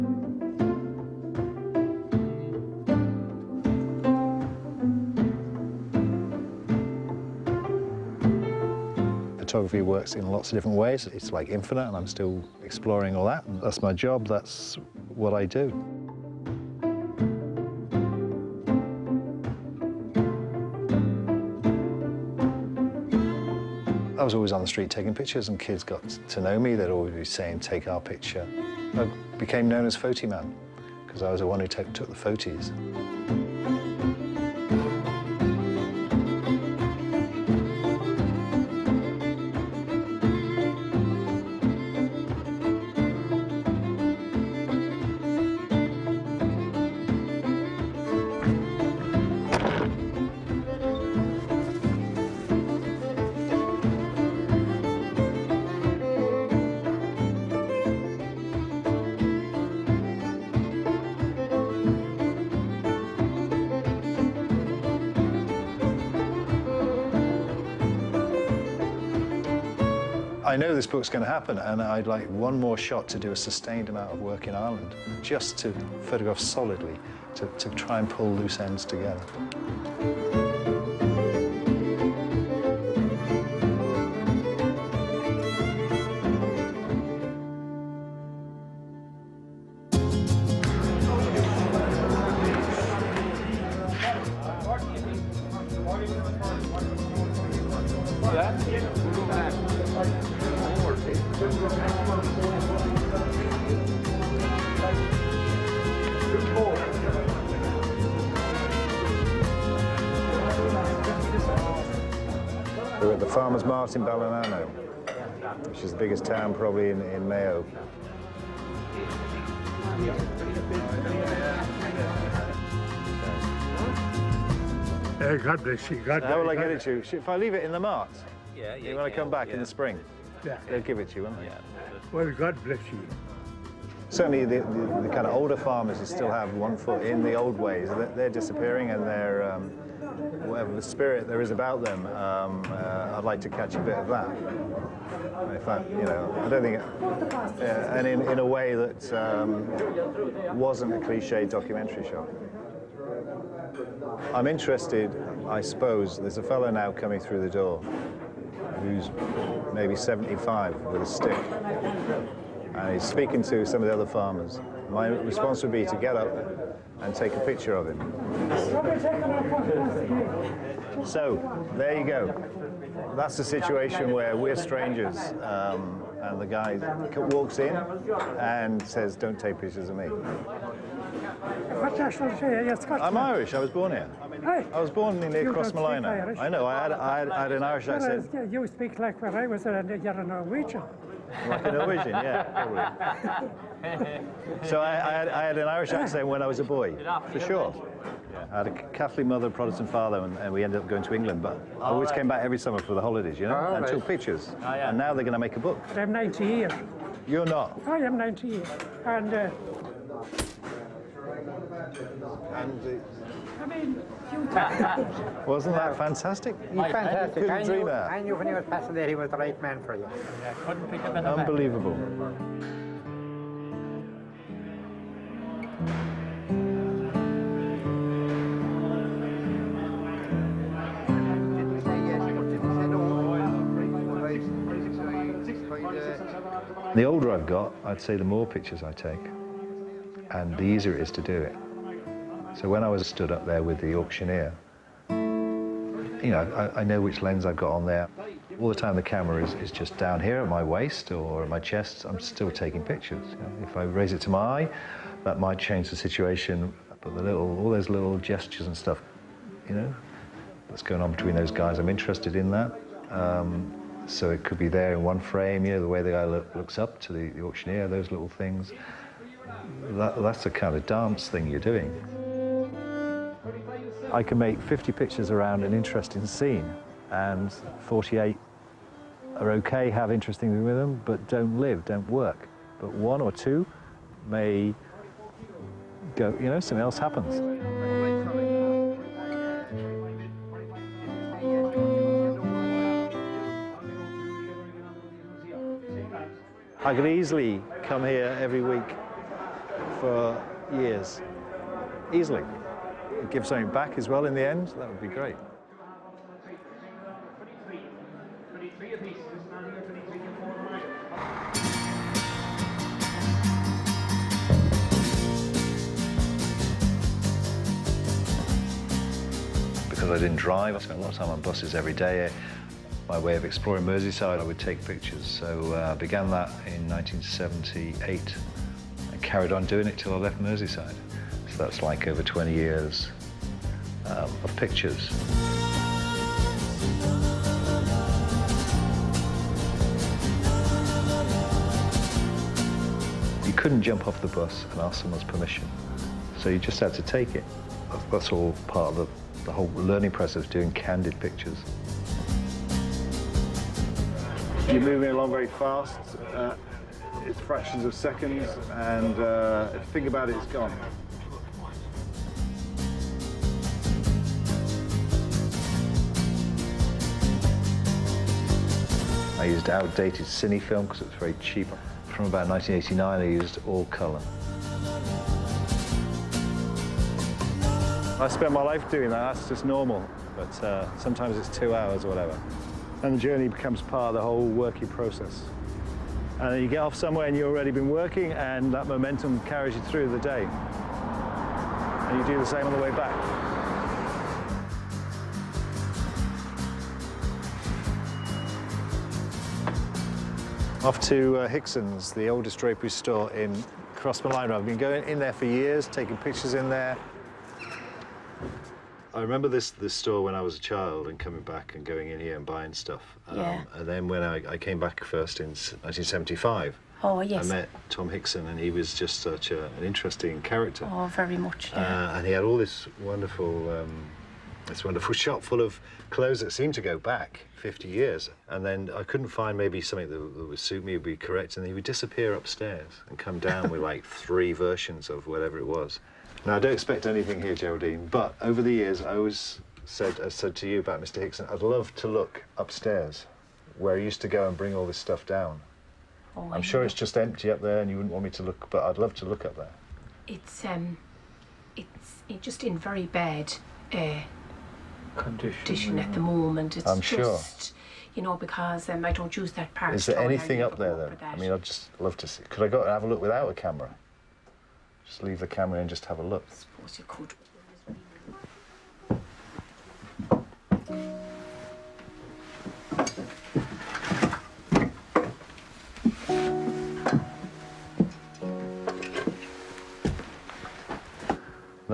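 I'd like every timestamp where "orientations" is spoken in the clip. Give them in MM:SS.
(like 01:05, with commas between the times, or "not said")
not said.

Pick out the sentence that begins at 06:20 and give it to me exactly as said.
But uh, sometimes it's two hours or whatever.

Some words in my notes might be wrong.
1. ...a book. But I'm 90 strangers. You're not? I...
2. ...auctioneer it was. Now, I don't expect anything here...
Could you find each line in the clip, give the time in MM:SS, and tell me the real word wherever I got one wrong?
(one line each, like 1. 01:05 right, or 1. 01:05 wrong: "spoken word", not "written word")
1. 03:25 wrong: "years", not "strangers"
2. 07:15 wrong: "whatever", not "auctioneer".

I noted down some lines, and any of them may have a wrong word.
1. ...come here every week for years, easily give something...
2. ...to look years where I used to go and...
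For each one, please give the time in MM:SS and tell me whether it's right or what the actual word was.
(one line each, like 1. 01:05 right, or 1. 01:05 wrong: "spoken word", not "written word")
1. 04:57 right
2. 07:21 wrong: "upstairs", not "years".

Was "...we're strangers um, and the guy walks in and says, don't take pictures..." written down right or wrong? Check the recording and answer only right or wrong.
right.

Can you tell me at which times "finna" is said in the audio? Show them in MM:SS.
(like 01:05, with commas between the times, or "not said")
not said.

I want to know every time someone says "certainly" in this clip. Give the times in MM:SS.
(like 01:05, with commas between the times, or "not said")
02:14.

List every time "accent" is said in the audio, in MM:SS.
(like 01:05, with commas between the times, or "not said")
03:07, 03:15.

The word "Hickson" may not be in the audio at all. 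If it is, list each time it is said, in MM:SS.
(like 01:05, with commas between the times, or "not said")
06:41, 06:58, 07:21.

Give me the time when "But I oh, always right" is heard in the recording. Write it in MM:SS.
03:21.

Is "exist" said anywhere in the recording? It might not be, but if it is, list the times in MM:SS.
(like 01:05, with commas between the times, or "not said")
not said.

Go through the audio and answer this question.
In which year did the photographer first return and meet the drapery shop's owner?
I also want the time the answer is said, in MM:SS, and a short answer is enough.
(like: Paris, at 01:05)
1975, at 06:55.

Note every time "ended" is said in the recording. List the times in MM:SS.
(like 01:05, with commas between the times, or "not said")
03:20.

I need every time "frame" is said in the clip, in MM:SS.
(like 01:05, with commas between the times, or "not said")
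04:25.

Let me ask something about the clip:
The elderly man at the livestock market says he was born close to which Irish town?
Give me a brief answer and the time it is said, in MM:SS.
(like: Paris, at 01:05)
Crossmolina, at 03:05.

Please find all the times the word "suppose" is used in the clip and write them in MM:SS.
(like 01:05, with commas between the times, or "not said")
02:35, 07:46.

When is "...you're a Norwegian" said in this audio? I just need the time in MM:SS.
03:09.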